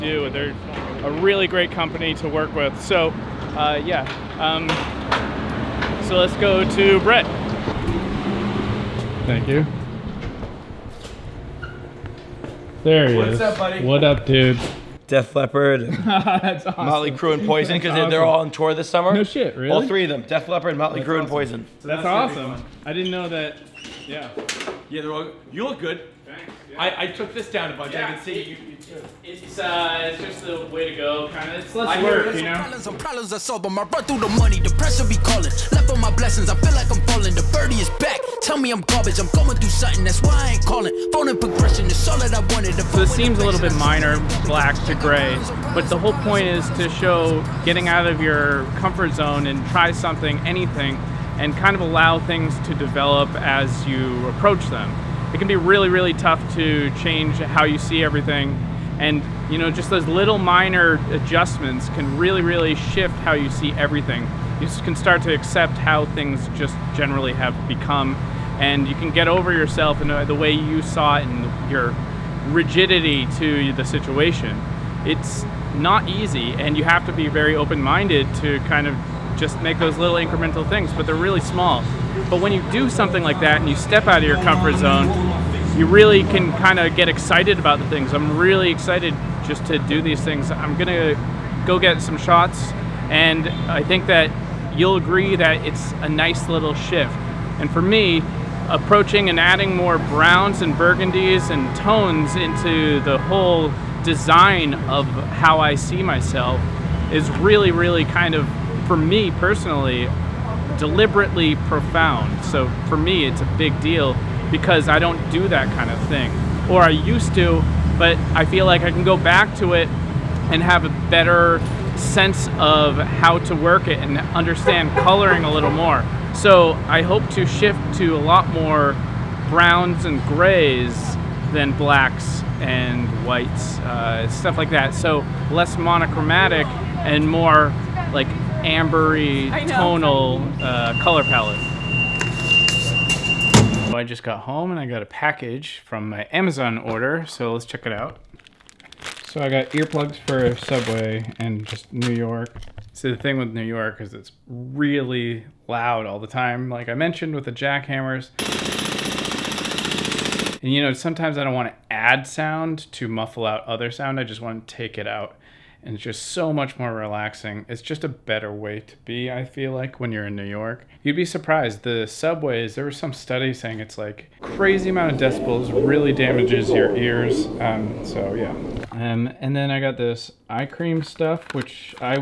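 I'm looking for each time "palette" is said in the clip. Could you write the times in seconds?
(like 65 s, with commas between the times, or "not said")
141 s.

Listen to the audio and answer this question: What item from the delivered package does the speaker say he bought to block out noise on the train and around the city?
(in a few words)
earplugs.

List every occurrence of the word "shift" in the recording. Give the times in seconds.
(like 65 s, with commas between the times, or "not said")
62 s, 96 s, 127 s.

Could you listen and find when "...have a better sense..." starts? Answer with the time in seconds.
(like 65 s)
120 s.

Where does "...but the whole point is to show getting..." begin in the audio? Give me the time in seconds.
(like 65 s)
45 s.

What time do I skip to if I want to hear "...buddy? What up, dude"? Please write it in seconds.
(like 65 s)
13 s.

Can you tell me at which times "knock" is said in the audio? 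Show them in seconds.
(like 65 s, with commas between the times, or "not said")
not said.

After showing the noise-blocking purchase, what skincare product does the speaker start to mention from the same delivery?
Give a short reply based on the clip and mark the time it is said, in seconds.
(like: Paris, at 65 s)
eye cream, at 180 s.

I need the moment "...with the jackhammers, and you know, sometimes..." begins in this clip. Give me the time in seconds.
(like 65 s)
157 s.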